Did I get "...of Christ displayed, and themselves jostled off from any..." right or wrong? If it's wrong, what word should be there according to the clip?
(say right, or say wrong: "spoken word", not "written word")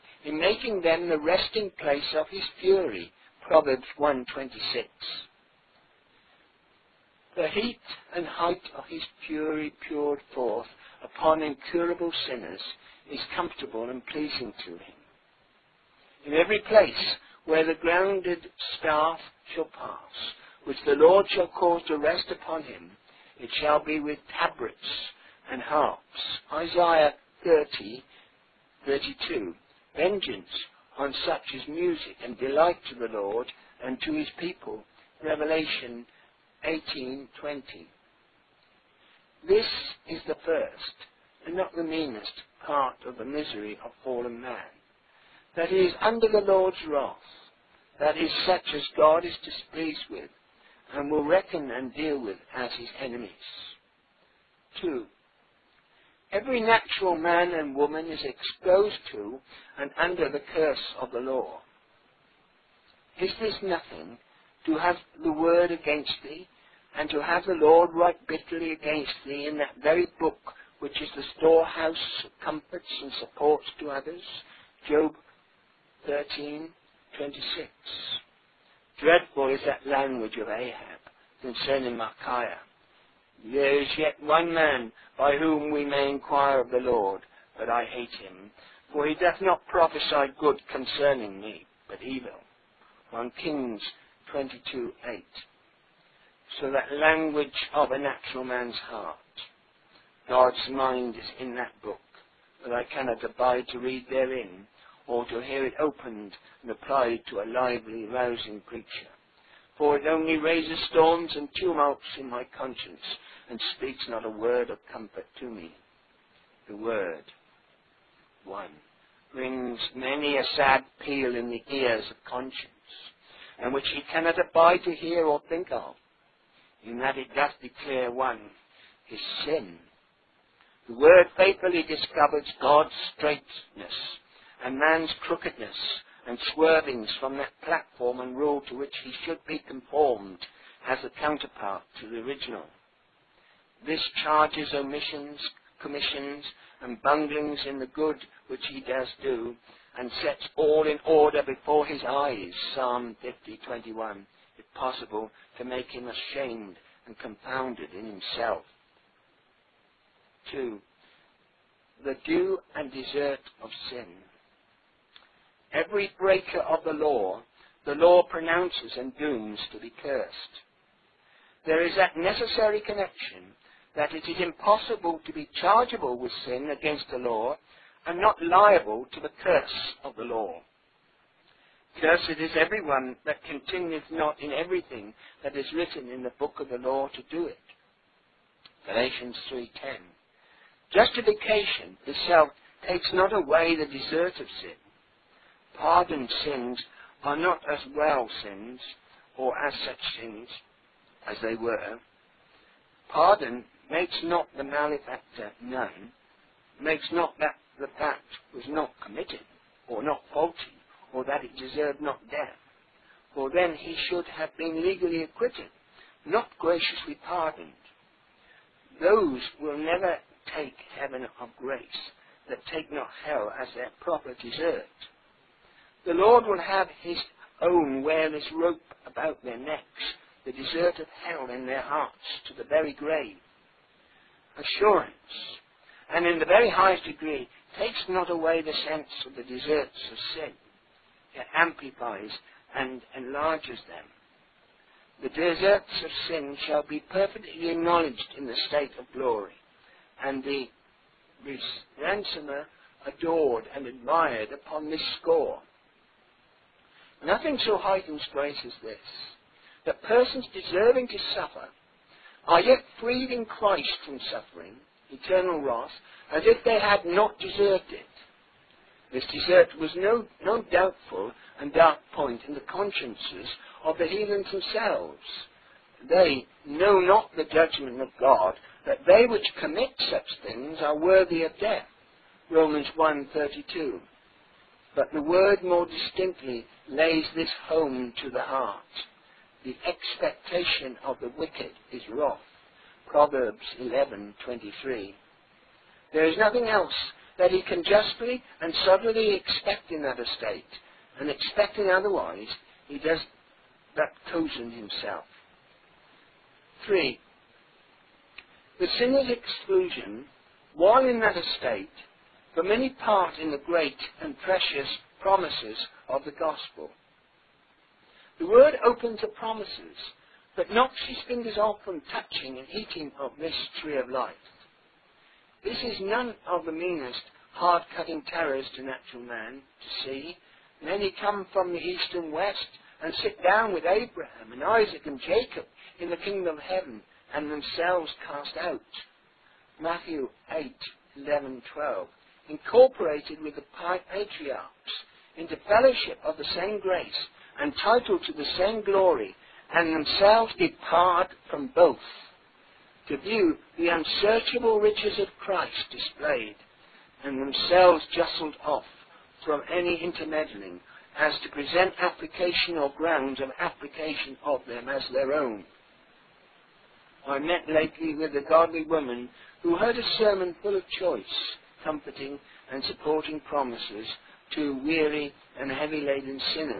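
right.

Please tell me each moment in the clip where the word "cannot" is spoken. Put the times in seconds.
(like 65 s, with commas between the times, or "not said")
102 s, 124 s.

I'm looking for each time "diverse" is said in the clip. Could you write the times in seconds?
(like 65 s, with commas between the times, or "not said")
not said.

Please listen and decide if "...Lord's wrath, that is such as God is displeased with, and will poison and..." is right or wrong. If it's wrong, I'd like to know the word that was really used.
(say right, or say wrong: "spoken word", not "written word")
wrong: "reckon", not "poison".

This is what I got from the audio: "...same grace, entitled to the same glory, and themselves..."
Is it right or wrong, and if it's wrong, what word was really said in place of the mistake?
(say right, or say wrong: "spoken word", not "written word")
right.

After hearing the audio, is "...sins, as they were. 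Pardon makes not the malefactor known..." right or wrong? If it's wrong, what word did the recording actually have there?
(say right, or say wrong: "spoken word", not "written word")
right.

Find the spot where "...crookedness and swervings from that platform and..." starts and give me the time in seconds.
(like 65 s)
135 s.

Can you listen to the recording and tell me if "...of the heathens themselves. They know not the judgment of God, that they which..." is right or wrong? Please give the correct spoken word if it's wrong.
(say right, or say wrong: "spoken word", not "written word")
right.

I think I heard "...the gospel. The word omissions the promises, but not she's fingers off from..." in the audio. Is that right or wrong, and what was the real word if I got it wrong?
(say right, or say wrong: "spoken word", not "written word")
wrong: "opens", not "omissions".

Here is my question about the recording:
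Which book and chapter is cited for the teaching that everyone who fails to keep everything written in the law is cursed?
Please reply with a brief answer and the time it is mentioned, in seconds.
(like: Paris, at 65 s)
Galatians 3:10, at 188 s.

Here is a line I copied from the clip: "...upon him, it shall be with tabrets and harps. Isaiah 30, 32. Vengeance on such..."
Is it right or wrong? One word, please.
right.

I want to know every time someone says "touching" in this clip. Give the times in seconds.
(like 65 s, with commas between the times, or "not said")
322 s.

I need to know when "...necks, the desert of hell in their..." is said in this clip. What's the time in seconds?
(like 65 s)
229 s.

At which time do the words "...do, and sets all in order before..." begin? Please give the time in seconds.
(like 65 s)
149 s.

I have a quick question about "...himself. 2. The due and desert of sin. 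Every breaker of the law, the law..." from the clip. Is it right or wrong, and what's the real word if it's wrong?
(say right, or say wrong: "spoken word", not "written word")
right.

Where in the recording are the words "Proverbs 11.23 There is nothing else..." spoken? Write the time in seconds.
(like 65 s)
293 s.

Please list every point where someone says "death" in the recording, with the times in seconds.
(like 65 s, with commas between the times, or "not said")
212 s, 281 s.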